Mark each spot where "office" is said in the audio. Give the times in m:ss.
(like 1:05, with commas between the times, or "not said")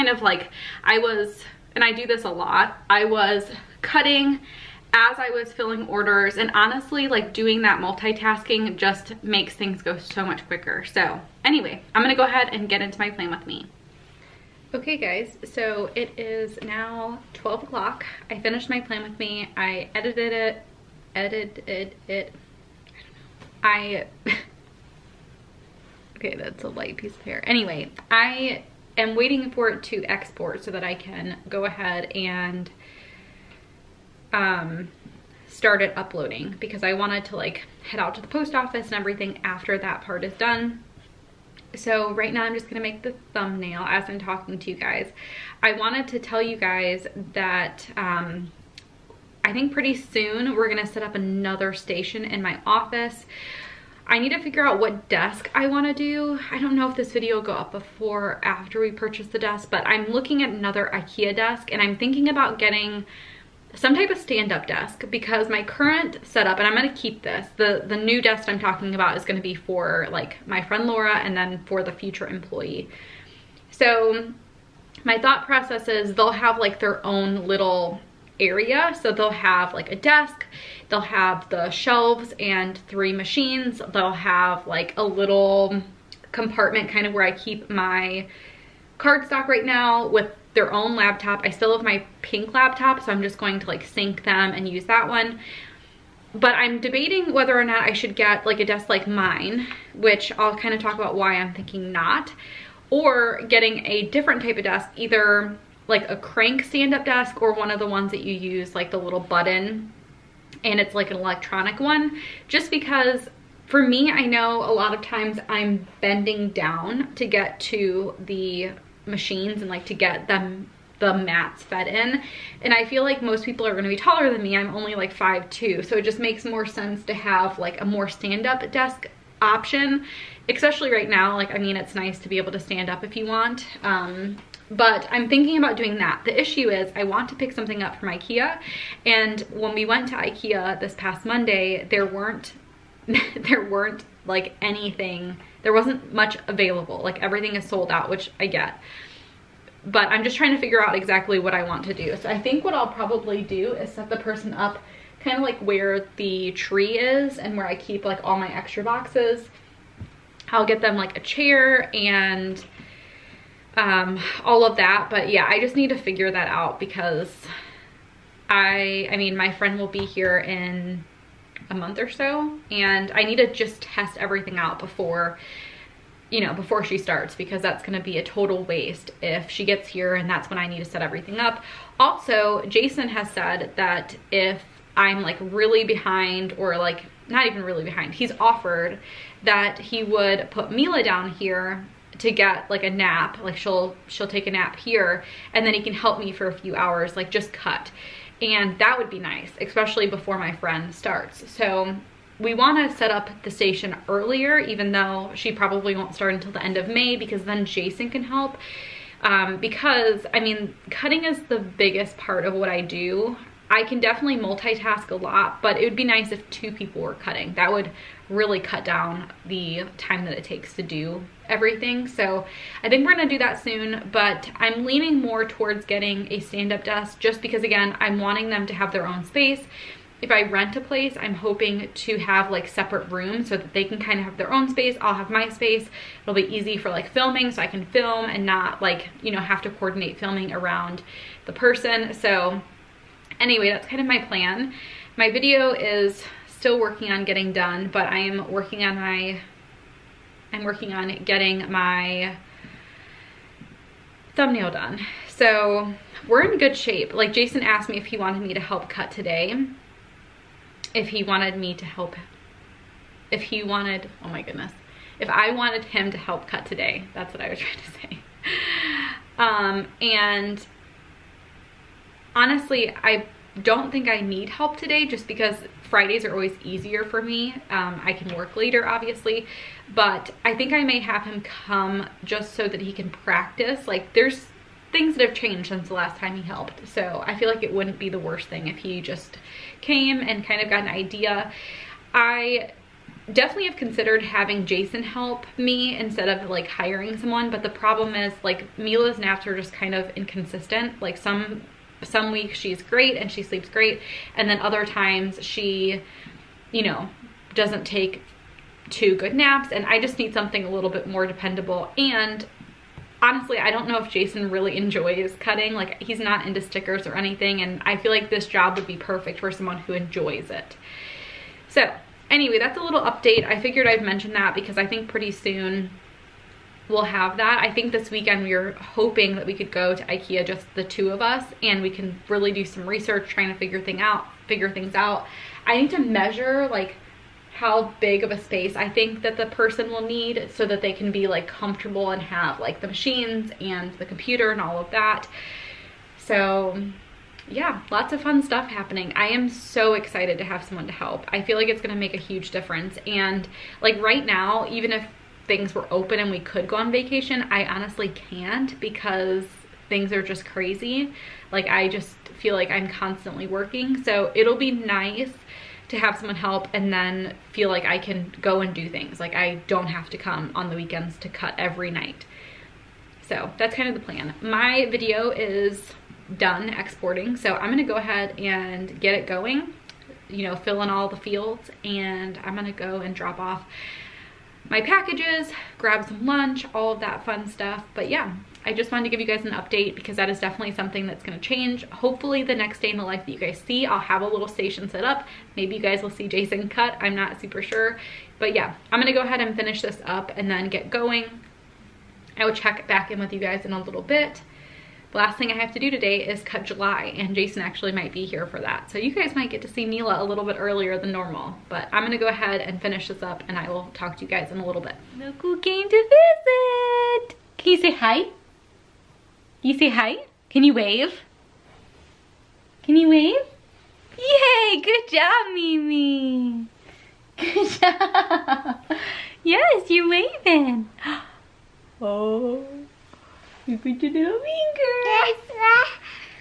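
0:38, 0:52.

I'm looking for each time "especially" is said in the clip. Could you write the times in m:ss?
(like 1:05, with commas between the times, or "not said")
2:10, 3:19.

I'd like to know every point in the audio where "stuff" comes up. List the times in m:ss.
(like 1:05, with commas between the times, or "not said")
5:48, 6:27.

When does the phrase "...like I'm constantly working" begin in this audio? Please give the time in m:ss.
6:02.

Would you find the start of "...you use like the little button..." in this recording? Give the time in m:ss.
1:48.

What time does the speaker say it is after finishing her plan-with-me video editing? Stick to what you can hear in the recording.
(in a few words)
12 o'clock.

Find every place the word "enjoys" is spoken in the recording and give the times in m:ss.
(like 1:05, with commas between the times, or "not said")
5:14, 5:19.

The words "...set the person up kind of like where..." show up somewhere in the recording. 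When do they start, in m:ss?
2:33.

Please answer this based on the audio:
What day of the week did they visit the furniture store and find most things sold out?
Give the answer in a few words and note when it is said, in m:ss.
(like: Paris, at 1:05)
Monday, at 2:21.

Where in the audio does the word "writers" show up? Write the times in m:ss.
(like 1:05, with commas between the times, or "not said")
not said.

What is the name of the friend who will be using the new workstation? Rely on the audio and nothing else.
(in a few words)
Laura.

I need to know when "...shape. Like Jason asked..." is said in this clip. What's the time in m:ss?
4:16.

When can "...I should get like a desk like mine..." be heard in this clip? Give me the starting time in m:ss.
1:37.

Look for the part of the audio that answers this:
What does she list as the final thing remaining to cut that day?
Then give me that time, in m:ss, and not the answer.
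6:46.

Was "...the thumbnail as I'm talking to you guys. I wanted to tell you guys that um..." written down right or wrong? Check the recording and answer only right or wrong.
right.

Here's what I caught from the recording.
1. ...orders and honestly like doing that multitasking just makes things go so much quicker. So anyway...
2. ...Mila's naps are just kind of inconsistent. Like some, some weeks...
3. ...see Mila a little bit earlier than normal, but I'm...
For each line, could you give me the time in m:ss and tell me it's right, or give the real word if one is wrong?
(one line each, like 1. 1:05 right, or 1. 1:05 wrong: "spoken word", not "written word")
1. 0:05 right
2. 4:58 right
3. 6:49 right.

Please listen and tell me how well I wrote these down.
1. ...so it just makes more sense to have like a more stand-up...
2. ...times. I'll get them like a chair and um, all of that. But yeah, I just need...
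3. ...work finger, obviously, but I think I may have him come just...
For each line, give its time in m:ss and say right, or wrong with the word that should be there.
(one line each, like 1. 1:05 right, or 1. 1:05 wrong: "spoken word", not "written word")
1. 2:05 right
2. 2:38 wrong: "boxes", not "times"
3. 4:38 wrong: "later", not "finger".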